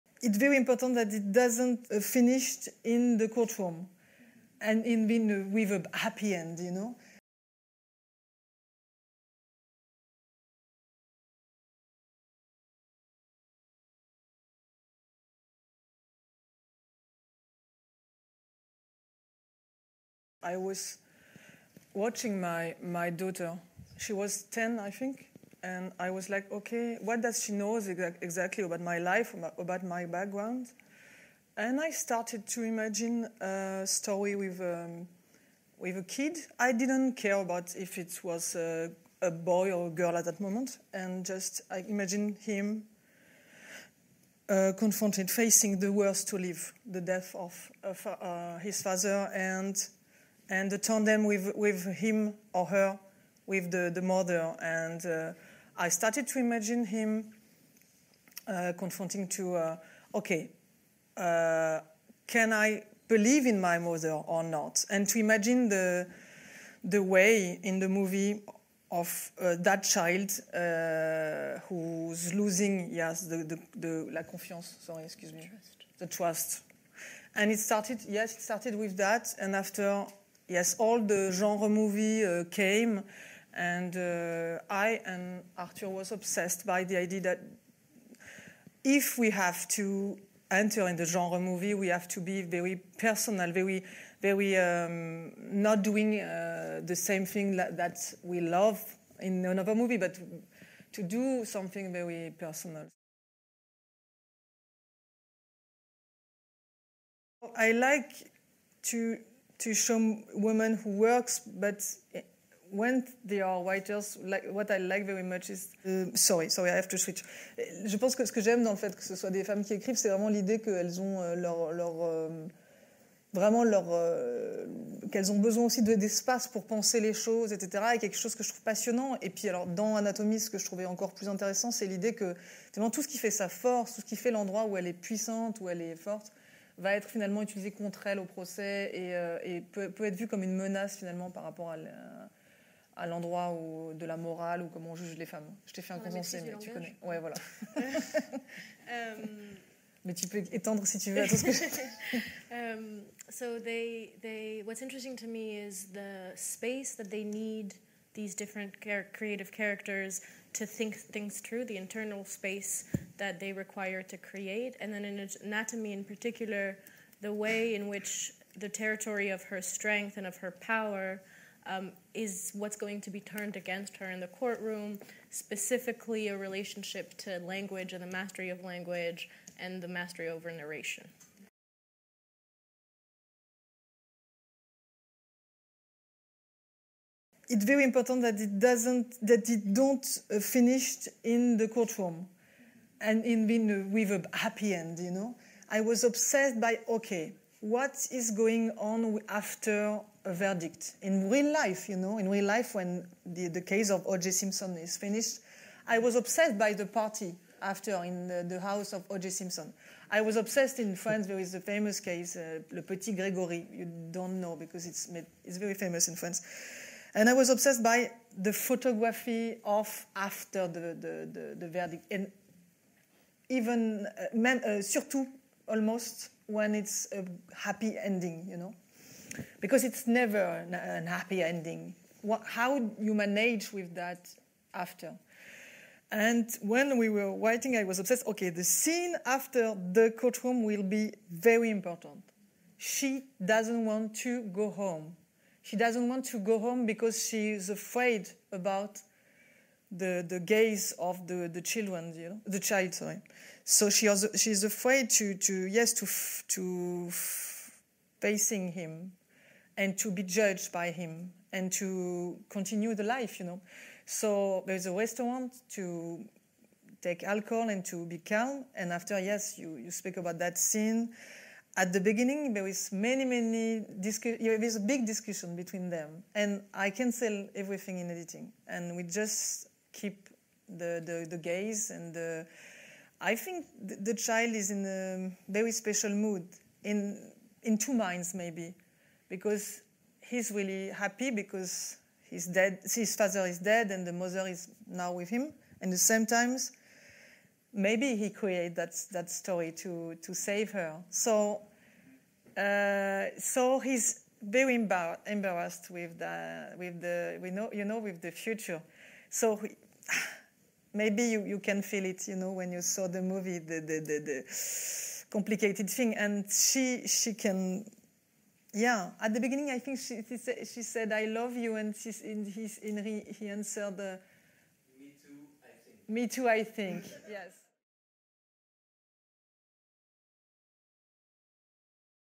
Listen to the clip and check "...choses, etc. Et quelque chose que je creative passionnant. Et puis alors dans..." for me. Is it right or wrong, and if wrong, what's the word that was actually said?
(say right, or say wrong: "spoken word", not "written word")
wrong: "trouve", not "creative".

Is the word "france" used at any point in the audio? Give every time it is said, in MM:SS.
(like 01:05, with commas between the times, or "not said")
03:30, 03:36.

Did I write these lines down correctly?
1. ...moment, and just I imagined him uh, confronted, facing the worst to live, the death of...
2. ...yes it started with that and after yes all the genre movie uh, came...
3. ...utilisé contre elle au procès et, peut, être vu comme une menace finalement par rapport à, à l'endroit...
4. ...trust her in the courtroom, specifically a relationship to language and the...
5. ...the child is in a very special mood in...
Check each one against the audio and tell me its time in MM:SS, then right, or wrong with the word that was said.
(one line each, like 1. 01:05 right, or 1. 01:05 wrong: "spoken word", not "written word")
1. 00:40 right
2. 01:18 right
3. 02:17 right
4. 02:53 wrong: "against", not "trust"
5. 04:43 right.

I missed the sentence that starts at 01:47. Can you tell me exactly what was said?
I like to to show women who works, but when they are writers, like, what I like very much is.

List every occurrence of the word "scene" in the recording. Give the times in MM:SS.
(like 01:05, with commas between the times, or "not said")
03:58, 04:30.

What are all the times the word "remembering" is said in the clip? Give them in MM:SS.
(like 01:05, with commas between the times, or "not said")
not said.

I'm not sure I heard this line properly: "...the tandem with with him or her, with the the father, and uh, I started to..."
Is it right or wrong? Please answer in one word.
wrong.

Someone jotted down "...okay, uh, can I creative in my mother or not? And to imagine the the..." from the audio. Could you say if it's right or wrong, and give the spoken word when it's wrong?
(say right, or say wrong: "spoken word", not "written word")
wrong: "believe", not "creative".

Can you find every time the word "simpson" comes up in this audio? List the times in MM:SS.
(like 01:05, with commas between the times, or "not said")
03:24, 03:29.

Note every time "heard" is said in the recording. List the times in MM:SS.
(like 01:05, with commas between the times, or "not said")
not said.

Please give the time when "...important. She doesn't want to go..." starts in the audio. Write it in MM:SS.
04:01.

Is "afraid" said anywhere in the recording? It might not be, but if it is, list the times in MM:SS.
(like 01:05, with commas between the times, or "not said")
04:07, 04:14.